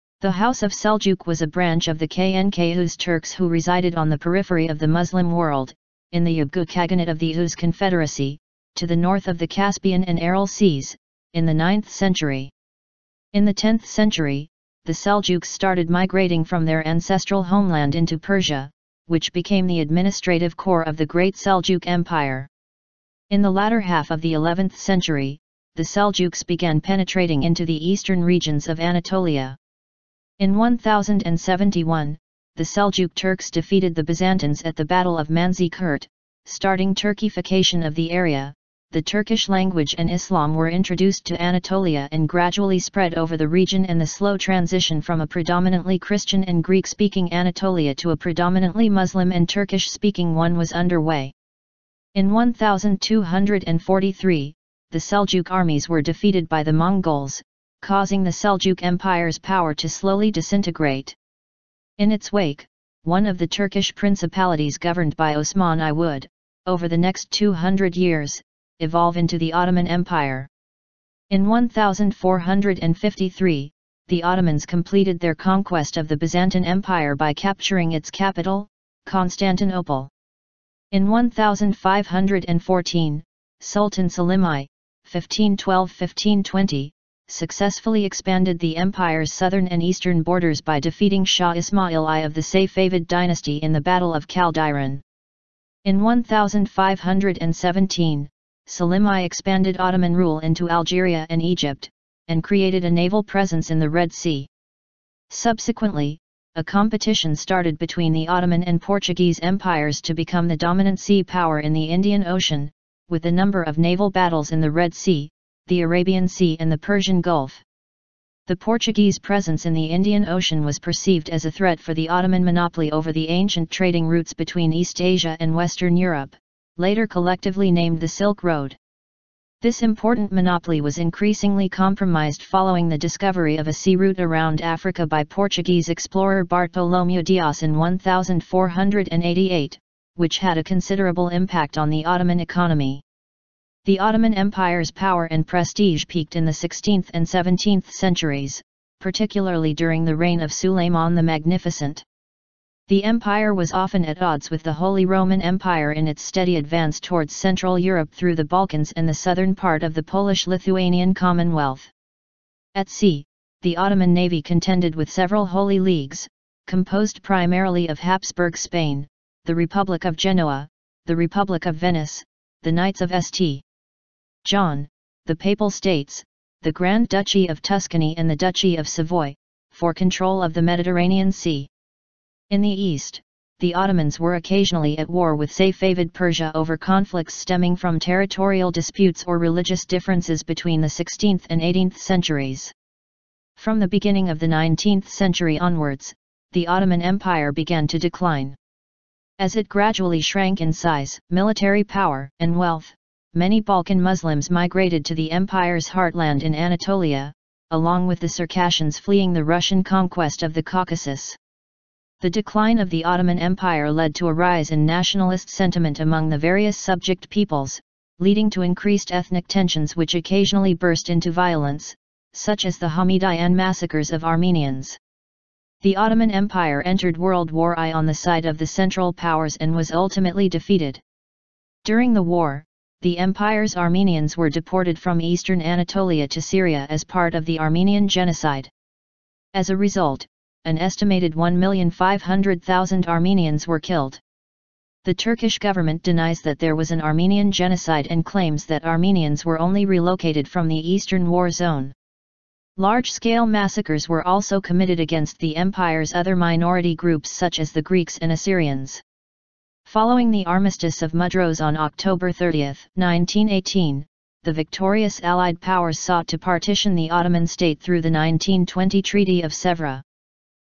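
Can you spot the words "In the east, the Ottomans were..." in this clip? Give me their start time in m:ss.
3:02.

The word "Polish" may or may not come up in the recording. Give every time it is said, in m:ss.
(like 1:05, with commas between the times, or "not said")
2:40.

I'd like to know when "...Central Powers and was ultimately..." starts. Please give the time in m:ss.
3:48.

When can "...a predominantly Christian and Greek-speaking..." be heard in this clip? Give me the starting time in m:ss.
0:45.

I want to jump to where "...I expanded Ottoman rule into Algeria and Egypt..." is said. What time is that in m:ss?
1:39.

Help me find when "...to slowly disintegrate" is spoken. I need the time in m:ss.
0:59.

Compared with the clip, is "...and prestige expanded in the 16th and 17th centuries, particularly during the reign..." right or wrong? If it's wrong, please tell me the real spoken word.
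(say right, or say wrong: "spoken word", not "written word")
wrong: "peaked", not "expanded".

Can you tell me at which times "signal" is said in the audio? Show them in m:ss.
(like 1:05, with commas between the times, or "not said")
not said.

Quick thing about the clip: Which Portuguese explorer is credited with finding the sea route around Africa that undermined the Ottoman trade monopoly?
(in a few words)
Bartolomeu Dias.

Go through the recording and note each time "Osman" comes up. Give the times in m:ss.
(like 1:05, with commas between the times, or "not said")
1:05.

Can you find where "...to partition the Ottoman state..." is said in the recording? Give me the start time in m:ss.
4:26.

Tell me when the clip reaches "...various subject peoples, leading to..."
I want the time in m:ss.
3:36.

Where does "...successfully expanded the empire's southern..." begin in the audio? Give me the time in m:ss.
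1:27.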